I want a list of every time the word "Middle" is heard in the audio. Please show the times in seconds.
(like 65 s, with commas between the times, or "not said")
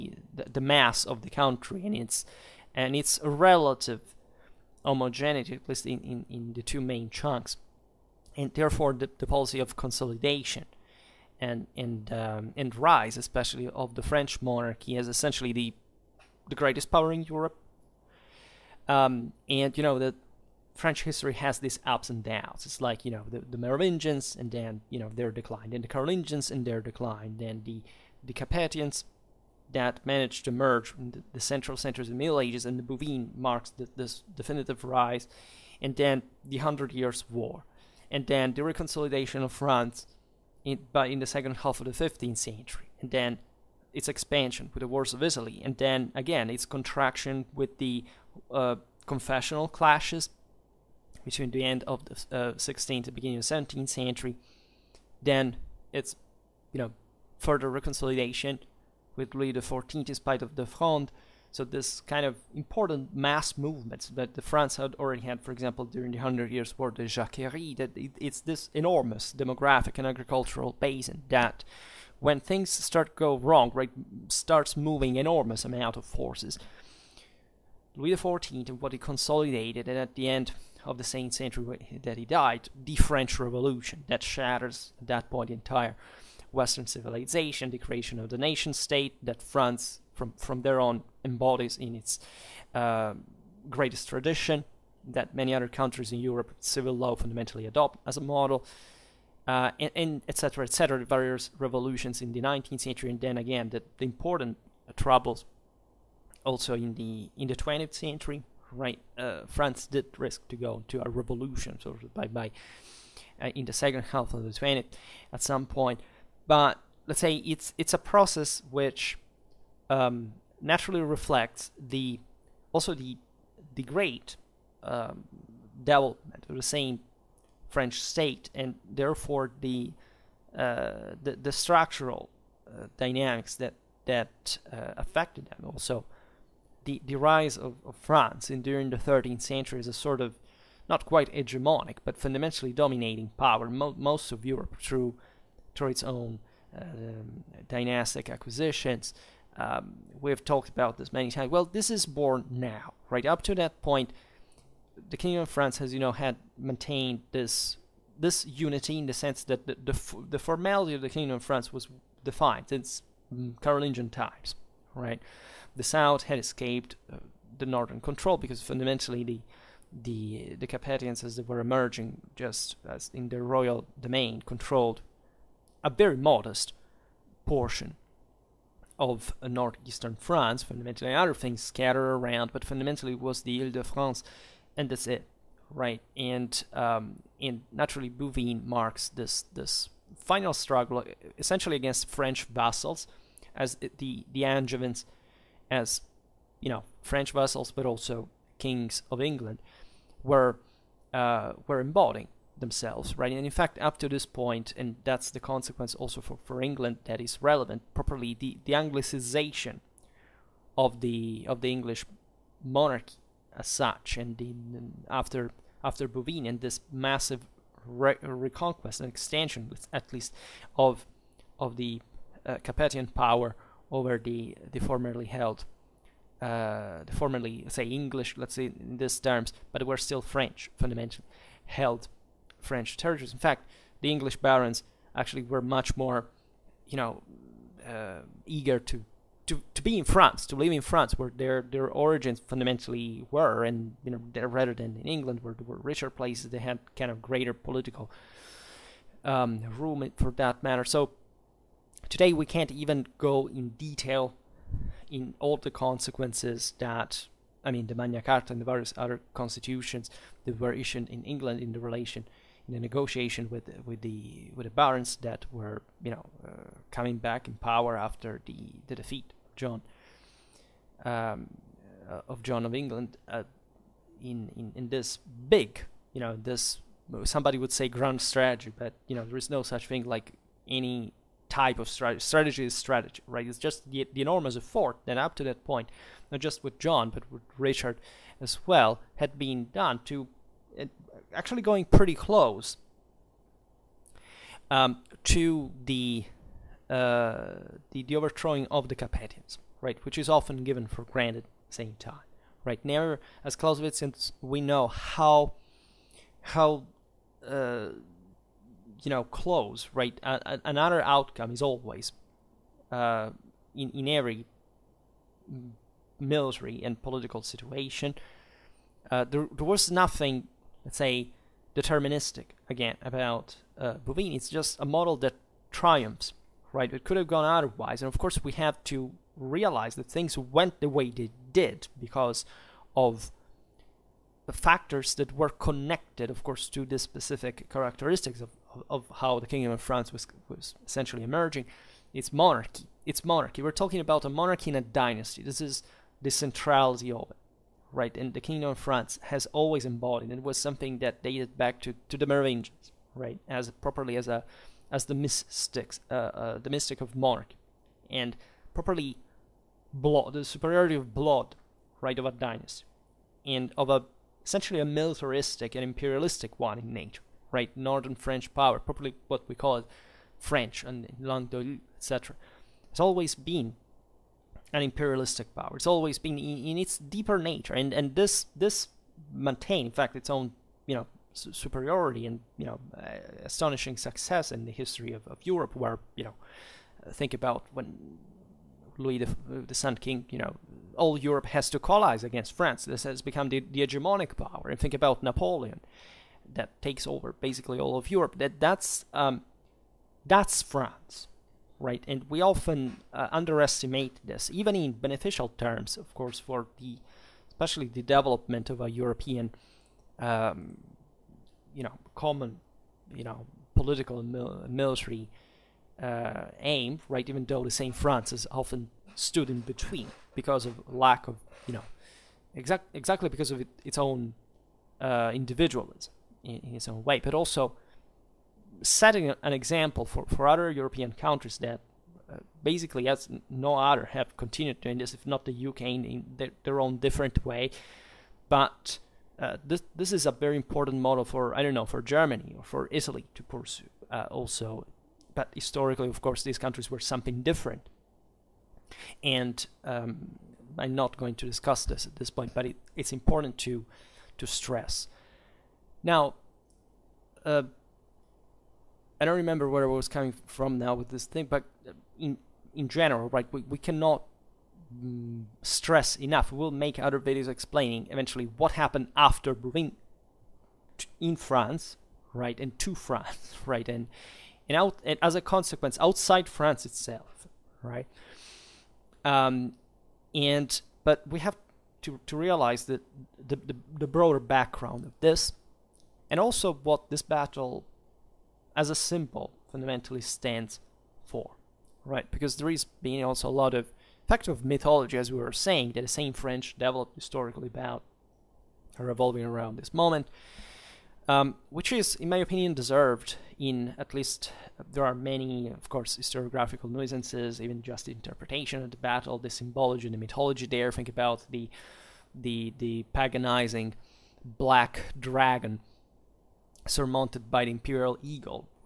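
32 s.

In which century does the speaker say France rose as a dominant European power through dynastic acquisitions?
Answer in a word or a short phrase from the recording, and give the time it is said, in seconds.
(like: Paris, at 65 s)
13th century, at 138 s.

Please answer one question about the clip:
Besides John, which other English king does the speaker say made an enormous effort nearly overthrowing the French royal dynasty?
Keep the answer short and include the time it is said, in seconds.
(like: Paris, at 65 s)
Richard, at 287 s.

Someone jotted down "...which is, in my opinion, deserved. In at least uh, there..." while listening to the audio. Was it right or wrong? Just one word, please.
right.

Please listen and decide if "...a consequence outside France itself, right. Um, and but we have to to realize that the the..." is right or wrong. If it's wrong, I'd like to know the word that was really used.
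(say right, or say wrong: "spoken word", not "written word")
right.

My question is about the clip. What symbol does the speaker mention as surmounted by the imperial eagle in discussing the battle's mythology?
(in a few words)
black dragon.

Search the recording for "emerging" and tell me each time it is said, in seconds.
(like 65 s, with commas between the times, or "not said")
171 s, 341 s.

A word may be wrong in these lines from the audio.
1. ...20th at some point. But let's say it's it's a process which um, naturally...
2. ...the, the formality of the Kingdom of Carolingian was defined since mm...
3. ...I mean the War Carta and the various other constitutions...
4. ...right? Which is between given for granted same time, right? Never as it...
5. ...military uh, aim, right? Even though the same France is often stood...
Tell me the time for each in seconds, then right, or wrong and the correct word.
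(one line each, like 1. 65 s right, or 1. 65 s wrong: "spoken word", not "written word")
1. 114 s right
2. 159 s wrong: "France", not "Carolingian"
3. 257 s wrong: "Magna", not "War"
4. 299 s wrong: "often", not "between"
5. 414 s right.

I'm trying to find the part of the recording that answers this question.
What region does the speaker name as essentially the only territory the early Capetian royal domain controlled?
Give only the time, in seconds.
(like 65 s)
183 s.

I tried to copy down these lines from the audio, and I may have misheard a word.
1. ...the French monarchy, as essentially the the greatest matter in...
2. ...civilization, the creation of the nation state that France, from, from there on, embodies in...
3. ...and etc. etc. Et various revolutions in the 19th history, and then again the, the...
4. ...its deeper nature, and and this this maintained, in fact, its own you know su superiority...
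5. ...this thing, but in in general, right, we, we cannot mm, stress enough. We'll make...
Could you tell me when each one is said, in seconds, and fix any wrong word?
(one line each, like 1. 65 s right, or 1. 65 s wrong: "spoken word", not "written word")
1. 13 s wrong: "power", not "matter"
2. 86 s right
3. 99 s wrong: "century", not "history"
4. 376 s right
5. 461 s right.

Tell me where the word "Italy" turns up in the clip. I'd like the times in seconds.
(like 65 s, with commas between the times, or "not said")
45 s, 442 s.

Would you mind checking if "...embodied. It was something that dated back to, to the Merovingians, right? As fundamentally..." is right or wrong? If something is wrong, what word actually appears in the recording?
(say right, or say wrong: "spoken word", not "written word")
wrong: "properly", not "fundamentally".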